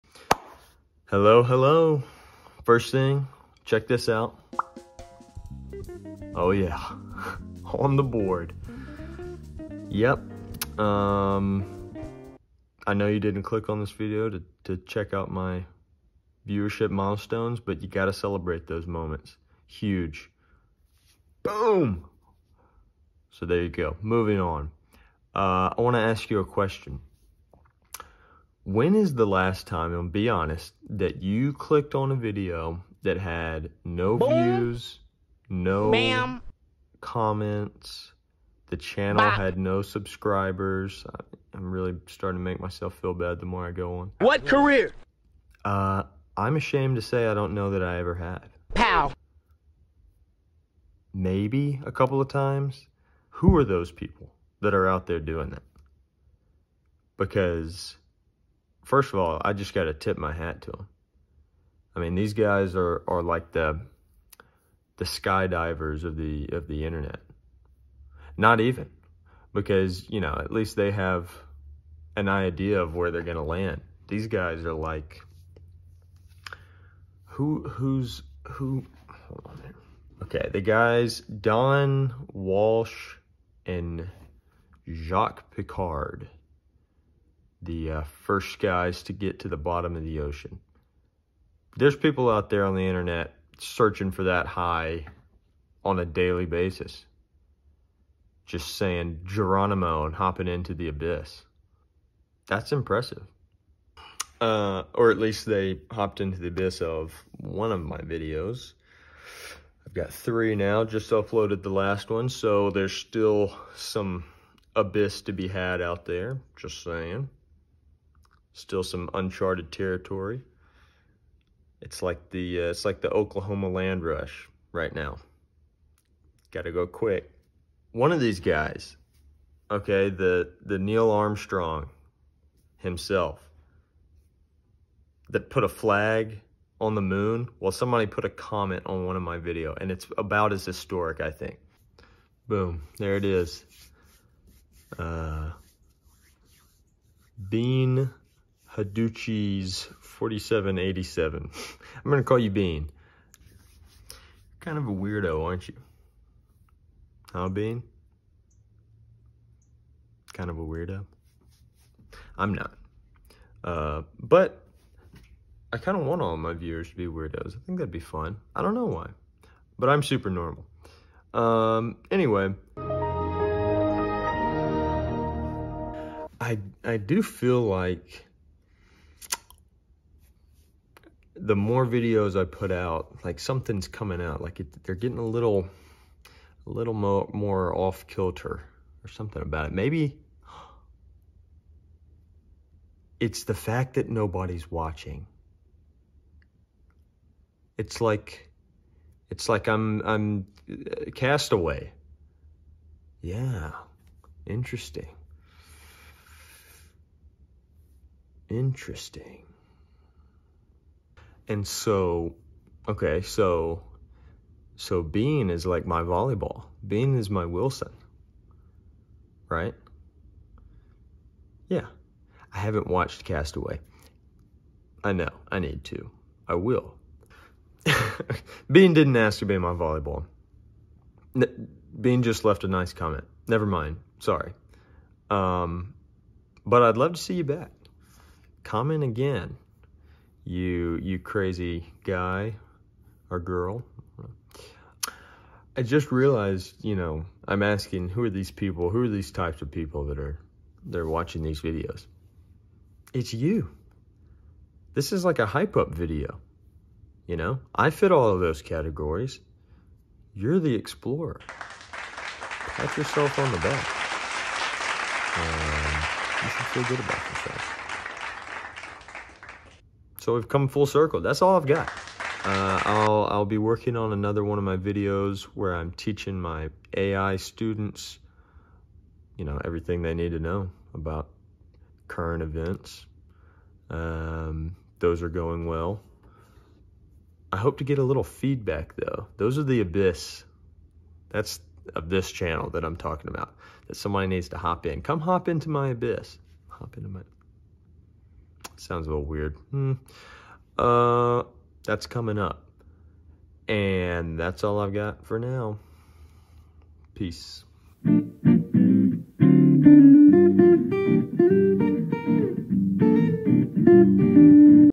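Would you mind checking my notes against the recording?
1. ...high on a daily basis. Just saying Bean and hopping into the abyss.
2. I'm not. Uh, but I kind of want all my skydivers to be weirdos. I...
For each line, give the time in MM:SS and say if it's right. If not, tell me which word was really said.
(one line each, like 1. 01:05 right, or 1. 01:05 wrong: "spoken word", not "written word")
1. 01:34 wrong: "Geronimo", not "Bean"
2. 02:42 wrong: "viewers", not "skydivers".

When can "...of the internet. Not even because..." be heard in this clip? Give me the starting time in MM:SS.
01:06.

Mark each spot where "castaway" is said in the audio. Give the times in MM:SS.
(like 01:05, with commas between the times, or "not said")
03:21, 03:43.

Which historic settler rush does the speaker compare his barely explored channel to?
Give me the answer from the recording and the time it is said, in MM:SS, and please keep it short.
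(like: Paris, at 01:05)
Oklahoma land rush, at 02:03.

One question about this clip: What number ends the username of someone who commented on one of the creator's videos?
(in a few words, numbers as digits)
4787.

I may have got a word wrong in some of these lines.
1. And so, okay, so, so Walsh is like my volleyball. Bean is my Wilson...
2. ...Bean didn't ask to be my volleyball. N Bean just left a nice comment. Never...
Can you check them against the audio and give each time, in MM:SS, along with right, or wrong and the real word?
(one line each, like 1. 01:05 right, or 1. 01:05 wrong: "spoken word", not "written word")
1. 03:31 wrong: "Bean", not "Walsh"
2. 03:48 right.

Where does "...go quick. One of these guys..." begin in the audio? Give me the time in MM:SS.
02:06.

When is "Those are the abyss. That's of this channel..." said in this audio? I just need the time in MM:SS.
04:49.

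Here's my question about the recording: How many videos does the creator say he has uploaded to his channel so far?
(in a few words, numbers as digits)
3.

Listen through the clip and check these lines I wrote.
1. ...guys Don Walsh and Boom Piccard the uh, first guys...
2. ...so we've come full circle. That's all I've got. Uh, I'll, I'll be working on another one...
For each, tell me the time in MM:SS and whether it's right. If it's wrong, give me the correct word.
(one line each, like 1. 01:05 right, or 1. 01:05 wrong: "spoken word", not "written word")
1. 01:20 wrong: "Jacques", not "Boom"
2. 04:30 right.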